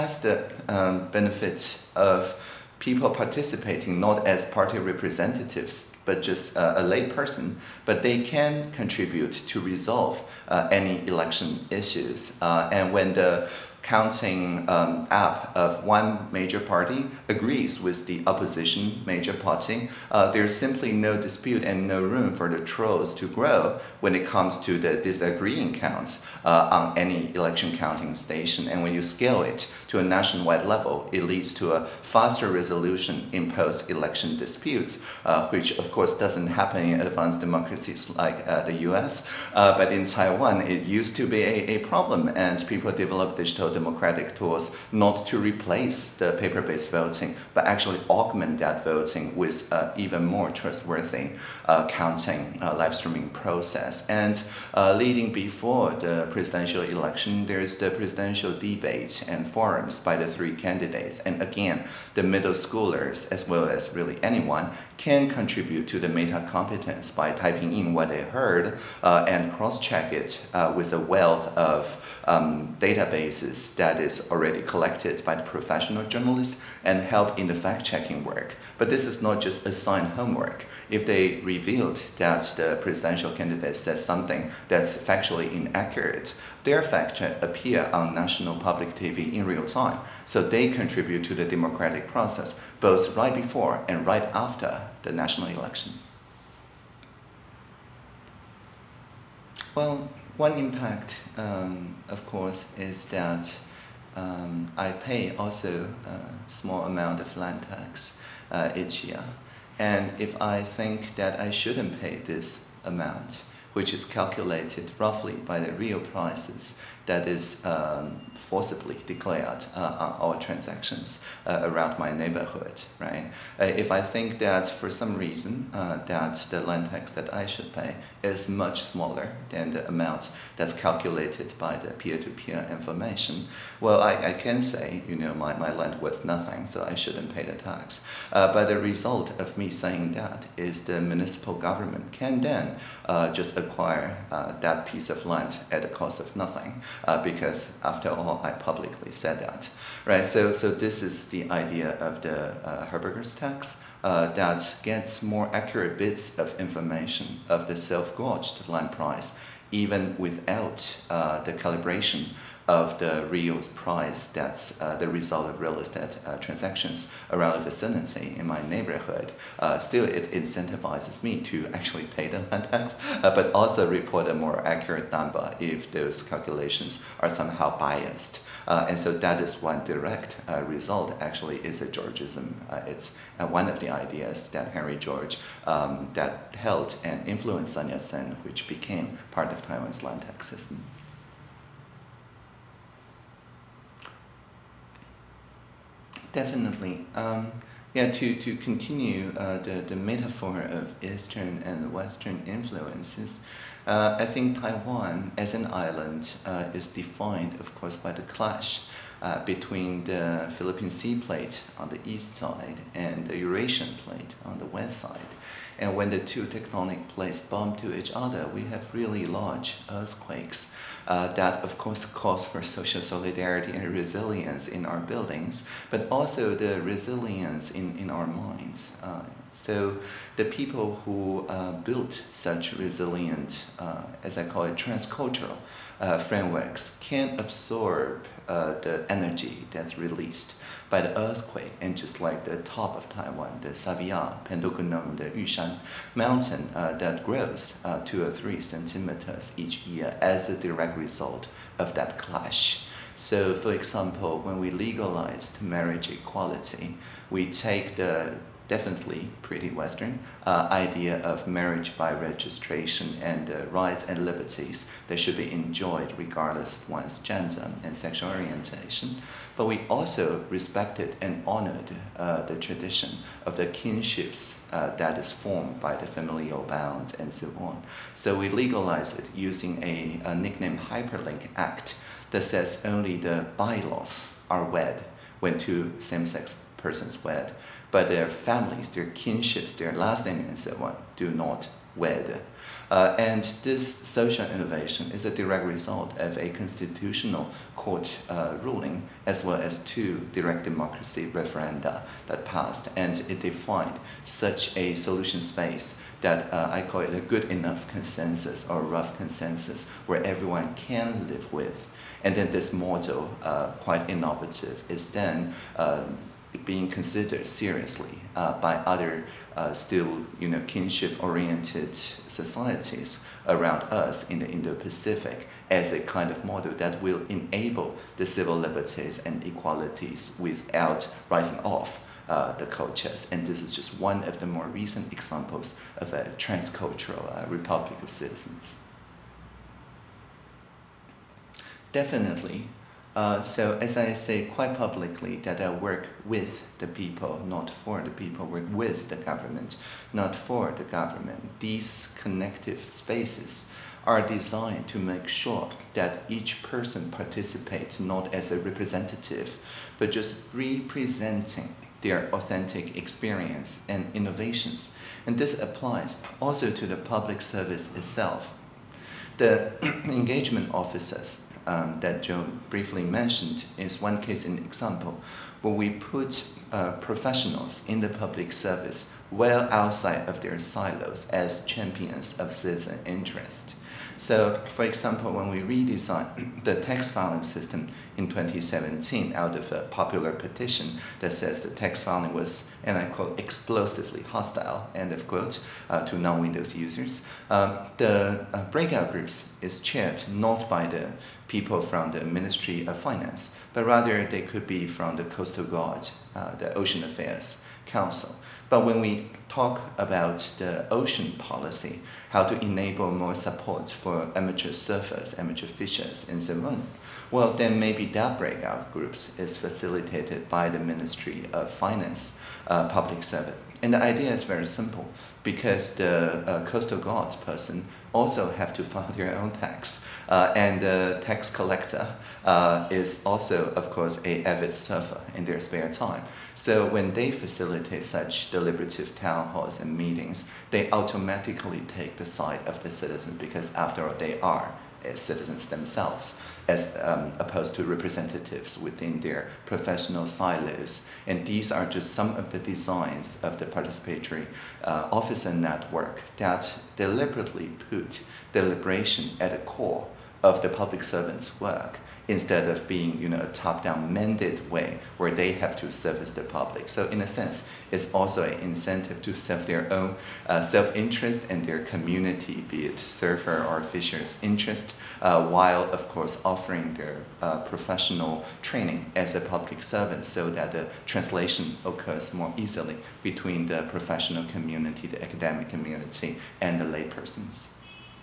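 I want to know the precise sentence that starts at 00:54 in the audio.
And uh, leading before the presidential election, there's the presidential debate and forums by the three candidates.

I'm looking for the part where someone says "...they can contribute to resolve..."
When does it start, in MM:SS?
00:08.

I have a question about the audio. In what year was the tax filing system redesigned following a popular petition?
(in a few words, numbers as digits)
2017.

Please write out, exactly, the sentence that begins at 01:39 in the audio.
Well, one impact, um, of course, is that um, I pay also a small amount of land tax uh, each year.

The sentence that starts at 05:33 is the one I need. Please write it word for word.
And this is just one of the more recent examples of a transcultural uh, republic of citizens.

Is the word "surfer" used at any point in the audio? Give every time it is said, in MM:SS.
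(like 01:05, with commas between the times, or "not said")
06:54, 07:14, 07:52.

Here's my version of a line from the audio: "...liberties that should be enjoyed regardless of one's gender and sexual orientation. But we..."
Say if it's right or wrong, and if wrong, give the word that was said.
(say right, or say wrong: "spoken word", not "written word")
right.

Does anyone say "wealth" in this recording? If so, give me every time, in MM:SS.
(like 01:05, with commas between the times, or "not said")
01:11.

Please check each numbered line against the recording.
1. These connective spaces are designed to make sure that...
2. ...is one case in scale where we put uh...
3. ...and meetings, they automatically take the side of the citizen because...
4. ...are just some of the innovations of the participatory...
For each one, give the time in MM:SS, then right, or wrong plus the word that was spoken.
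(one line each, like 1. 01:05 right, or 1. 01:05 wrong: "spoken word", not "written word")
1. 05:51 right
2. 06:13 wrong: "example", not "scale"
3. 07:19 right
4. 07:31 wrong: "designs", not "innovations".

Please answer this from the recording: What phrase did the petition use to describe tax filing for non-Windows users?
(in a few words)
explosively hostile.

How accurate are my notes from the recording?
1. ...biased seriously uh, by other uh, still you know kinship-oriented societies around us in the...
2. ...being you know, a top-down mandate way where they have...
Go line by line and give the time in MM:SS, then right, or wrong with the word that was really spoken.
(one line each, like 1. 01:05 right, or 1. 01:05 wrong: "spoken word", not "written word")
1. 05:16 wrong: "considered", not "biased"
2. 07:42 right.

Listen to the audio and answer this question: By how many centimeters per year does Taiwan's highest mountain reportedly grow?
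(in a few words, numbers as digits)
2 or 3.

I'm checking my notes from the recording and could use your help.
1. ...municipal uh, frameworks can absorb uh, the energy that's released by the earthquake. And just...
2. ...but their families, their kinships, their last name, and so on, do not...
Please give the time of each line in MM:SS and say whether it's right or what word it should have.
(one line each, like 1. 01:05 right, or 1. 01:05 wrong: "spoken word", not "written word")
1. 03:54 wrong: "transcultural", not "municipal"
2. 04:47 right.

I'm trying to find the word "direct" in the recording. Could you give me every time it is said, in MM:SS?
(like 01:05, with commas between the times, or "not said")
02:59, 04:10, 04:55, 05:00.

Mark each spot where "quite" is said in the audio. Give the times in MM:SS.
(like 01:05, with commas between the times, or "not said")
05:13, 05:44.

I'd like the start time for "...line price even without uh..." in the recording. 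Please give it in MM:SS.
02:38.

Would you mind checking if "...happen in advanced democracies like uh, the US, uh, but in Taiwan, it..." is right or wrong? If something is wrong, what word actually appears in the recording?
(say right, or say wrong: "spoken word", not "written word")
right.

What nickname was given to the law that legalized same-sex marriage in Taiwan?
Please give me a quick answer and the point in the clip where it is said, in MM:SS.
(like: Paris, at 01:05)
Hyperlink Act, at 04:40.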